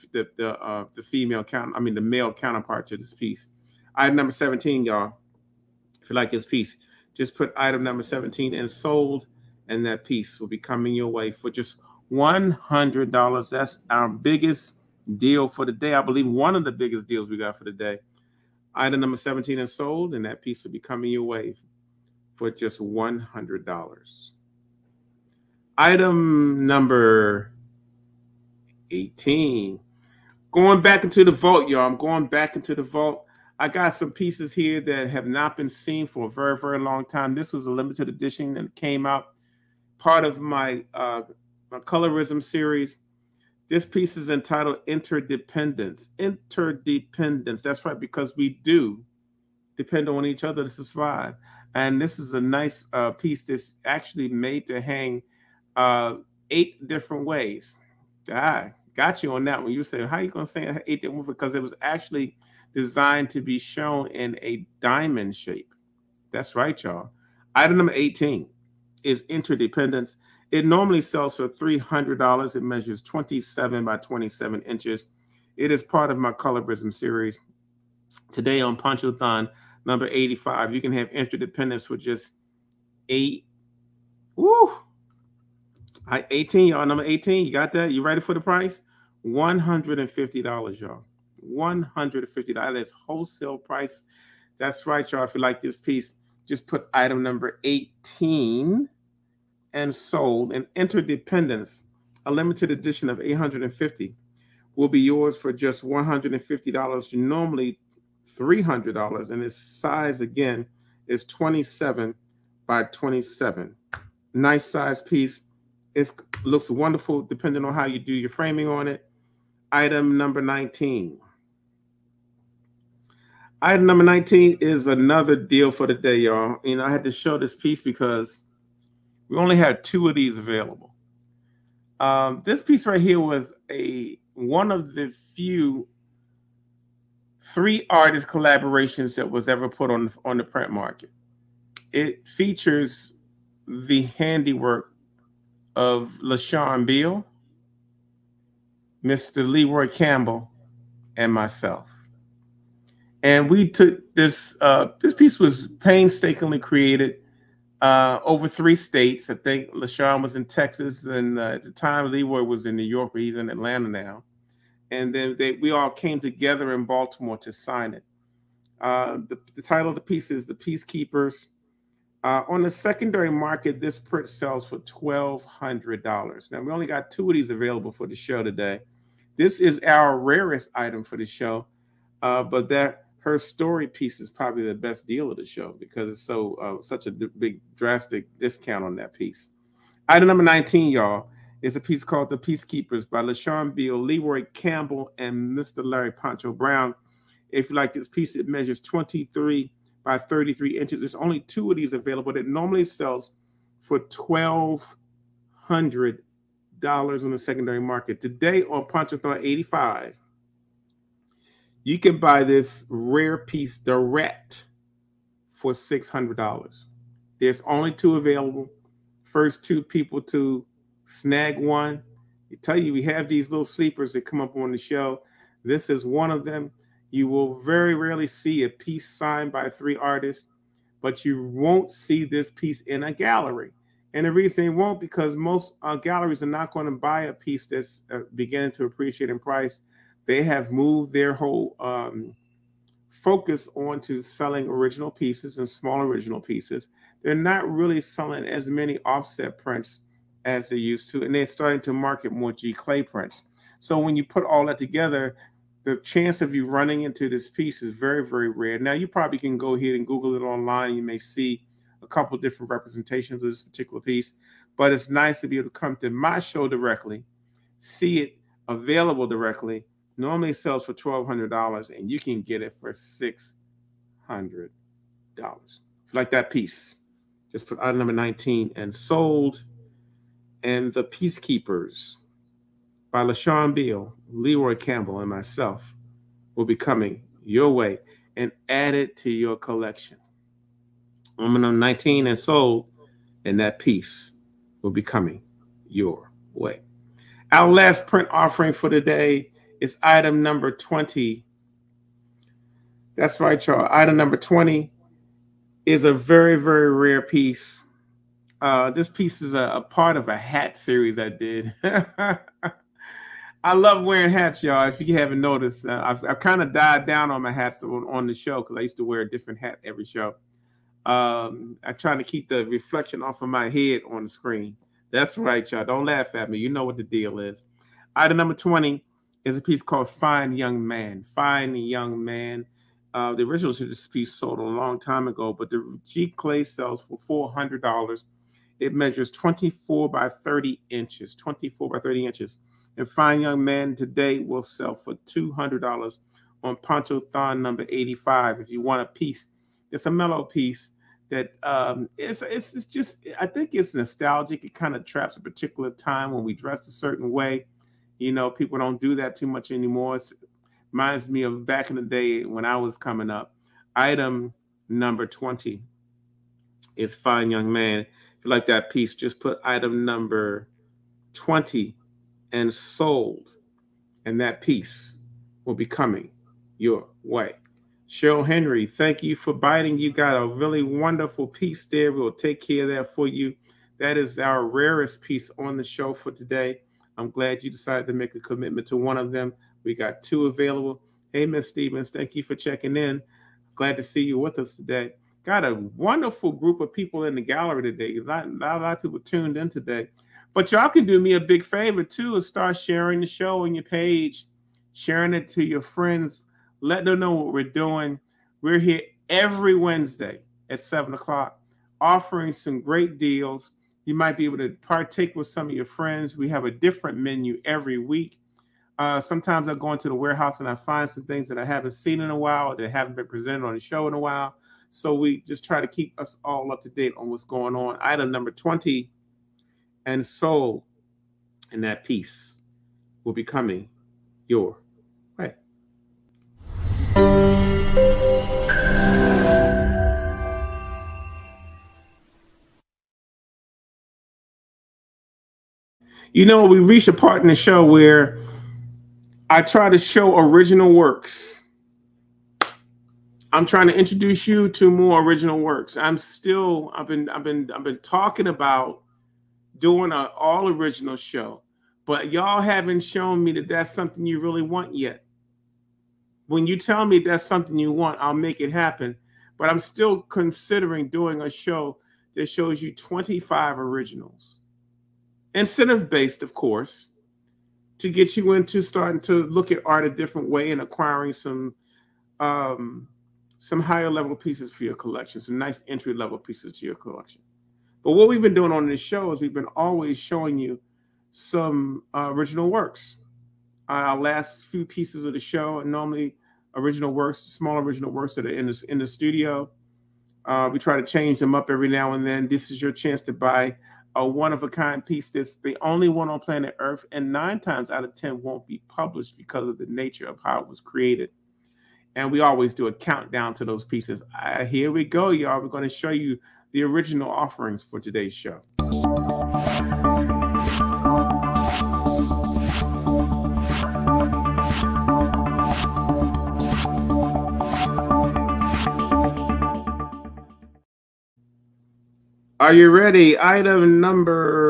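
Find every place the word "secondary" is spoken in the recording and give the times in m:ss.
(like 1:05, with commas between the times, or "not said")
2:52, 3:27.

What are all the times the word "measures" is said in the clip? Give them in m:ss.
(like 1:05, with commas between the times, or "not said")
1:12, 3:18, 5:38.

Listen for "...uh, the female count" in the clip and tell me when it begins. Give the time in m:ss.
0:00.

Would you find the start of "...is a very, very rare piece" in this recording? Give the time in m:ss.
5:05.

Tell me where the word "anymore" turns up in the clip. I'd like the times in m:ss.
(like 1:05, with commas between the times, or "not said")
5:59.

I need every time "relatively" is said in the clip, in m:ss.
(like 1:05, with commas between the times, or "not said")
not said.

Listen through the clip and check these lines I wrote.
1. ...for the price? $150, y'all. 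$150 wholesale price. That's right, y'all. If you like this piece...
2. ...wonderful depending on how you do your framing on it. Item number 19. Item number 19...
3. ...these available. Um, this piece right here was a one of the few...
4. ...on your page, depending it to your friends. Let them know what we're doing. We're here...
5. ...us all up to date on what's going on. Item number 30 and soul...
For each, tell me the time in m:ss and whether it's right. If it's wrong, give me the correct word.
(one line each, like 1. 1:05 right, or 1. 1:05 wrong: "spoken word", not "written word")
1. 1:28 right
2. 1:56 right
3. 2:10 right
4. 6:43 wrong: "sharing", not "depending"
5. 7:06 wrong: "20", not "30".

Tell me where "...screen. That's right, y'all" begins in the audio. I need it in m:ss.
5:24.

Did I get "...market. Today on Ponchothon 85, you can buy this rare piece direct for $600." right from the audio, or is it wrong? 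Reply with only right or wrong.
right.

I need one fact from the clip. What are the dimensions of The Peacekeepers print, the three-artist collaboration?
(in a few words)
23 by 33 inches.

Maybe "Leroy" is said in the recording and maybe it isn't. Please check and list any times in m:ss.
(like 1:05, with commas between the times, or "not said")
2:29, 2:42, 3:14, 4:44.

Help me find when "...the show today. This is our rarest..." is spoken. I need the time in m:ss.
2:58.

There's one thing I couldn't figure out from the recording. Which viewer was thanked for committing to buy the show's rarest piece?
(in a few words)
Cheryl Henry.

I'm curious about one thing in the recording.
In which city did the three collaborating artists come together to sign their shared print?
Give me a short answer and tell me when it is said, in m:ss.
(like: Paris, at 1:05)
Baltimore, at 2:46.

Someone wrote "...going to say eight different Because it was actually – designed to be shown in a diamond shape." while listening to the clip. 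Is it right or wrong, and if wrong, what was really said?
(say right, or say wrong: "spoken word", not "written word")
right.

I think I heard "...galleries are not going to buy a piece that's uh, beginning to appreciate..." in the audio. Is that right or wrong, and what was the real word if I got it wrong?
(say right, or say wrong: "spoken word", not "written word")
right.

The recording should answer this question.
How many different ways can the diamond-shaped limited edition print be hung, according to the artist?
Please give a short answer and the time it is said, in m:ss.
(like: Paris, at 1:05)
8, at 0:56.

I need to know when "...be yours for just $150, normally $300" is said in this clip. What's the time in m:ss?
1:44.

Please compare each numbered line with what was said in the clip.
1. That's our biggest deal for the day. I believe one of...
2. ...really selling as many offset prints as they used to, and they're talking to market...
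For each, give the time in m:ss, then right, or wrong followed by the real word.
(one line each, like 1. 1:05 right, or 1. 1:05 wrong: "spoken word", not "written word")
1. 0:13 right
2. 4:07 wrong: "starting", not "talking".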